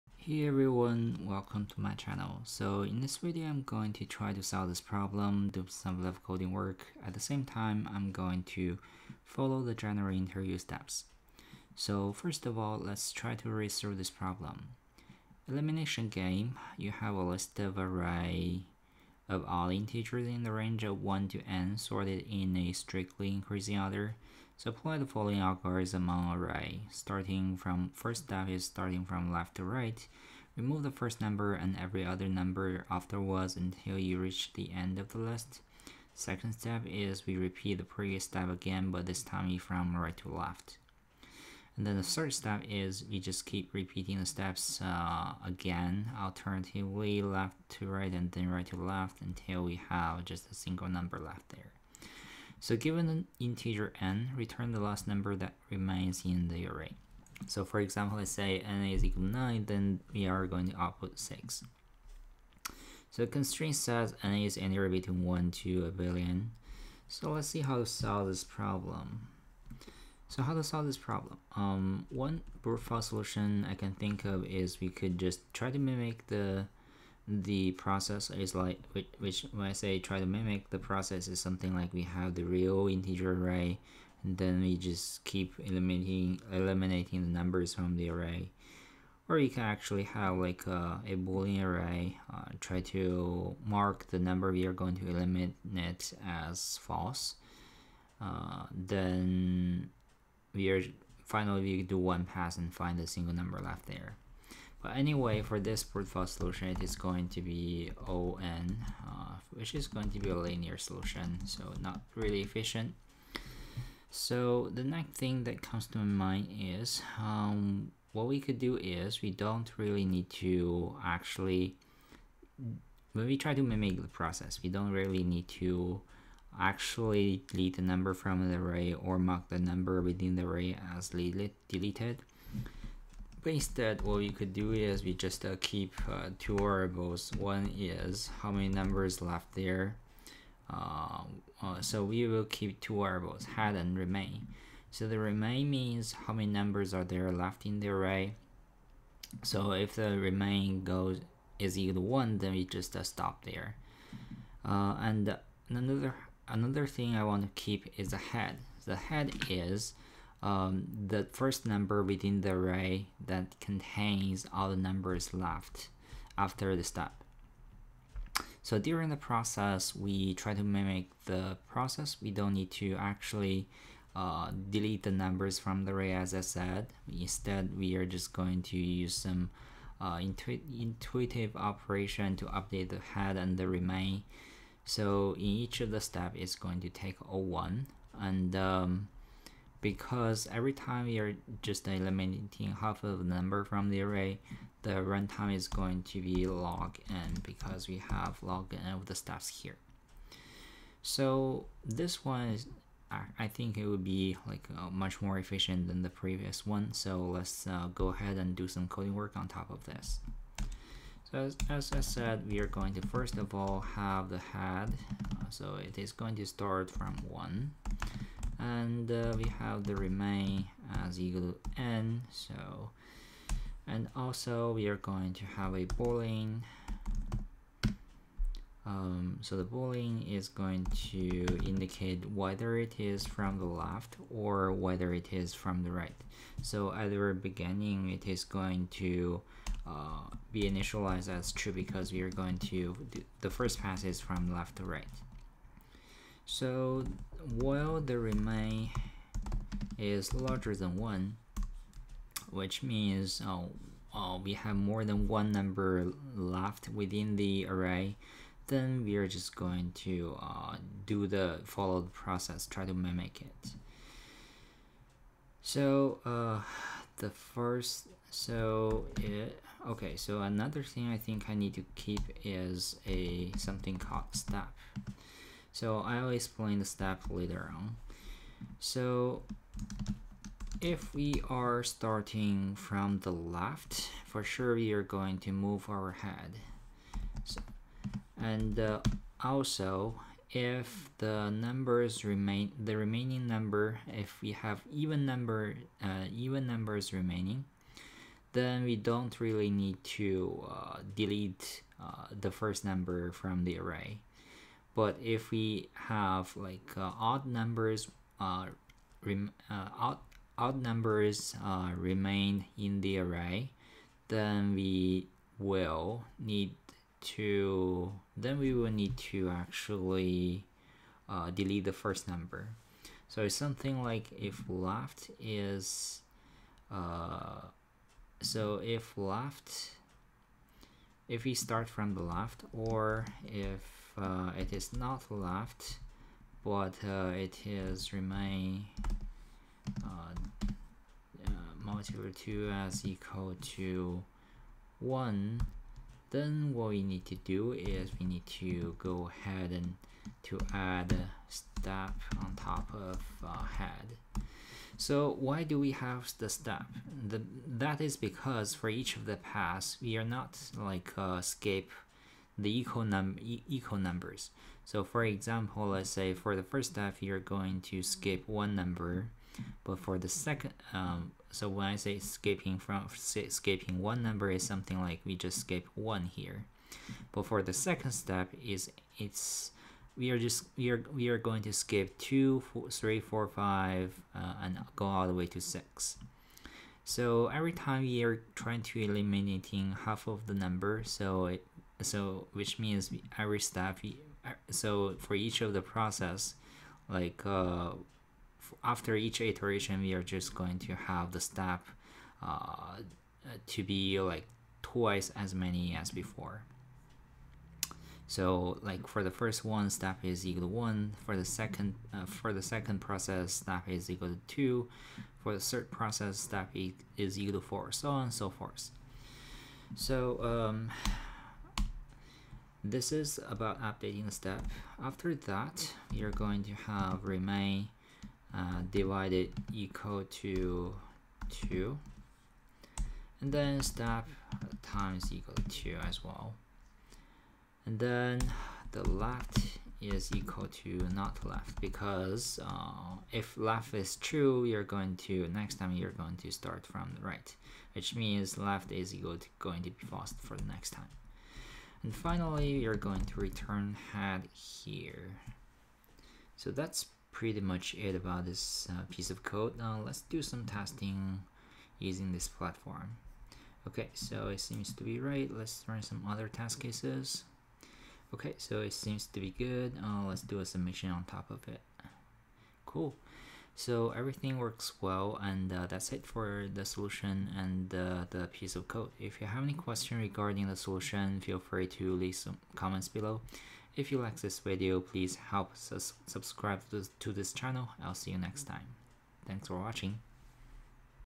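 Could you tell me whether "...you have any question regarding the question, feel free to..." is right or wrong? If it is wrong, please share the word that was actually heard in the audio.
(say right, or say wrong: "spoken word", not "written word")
wrong: "solution", not "question".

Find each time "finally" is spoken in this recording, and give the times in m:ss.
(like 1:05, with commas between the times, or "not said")
1:41, 7:32.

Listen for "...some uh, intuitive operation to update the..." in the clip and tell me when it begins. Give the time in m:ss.
2:59.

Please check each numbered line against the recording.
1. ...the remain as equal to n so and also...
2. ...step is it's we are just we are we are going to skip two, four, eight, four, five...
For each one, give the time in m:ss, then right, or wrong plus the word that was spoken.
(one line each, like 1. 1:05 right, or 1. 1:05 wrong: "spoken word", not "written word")
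1. 3:39 right
2. 6:18 wrong: "three", not "eight".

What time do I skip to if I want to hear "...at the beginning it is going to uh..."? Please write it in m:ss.
3:56.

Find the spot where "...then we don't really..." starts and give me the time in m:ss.
4:58.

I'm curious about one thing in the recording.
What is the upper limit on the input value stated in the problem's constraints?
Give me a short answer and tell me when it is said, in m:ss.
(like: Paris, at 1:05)
a billion, at 1:05.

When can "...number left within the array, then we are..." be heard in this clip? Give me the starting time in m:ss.
4:15.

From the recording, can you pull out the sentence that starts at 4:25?
So uh, the first, so it, okay, so another thing I think I need to keep is a something called step.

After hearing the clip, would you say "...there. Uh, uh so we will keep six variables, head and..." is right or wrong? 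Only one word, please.
wrong.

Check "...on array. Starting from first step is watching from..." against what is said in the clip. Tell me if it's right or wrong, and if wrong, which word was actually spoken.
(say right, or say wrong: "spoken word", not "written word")
wrong: "starting", not "watching".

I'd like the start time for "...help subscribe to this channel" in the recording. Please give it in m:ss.
8:05.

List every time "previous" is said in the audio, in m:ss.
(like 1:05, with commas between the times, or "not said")
0:37, 3:26.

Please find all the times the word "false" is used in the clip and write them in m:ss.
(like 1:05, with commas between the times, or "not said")
1:36, 7:30.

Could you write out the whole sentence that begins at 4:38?
So if we are starting from the left, for sure we are going to move our head.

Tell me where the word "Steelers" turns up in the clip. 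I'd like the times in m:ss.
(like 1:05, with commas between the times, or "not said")
not said.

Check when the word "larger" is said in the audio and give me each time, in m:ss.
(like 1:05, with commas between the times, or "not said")
4:10.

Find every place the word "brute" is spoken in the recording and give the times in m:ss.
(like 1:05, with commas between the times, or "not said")
1:12, 1:45.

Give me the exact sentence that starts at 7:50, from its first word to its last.
Uh, let's do a submission on top of it.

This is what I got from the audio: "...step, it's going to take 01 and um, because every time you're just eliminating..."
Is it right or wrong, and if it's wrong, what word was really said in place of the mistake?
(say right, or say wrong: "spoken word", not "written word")
right.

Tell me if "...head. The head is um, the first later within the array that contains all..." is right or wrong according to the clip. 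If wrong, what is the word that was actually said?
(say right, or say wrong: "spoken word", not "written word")
wrong: "number", not "later".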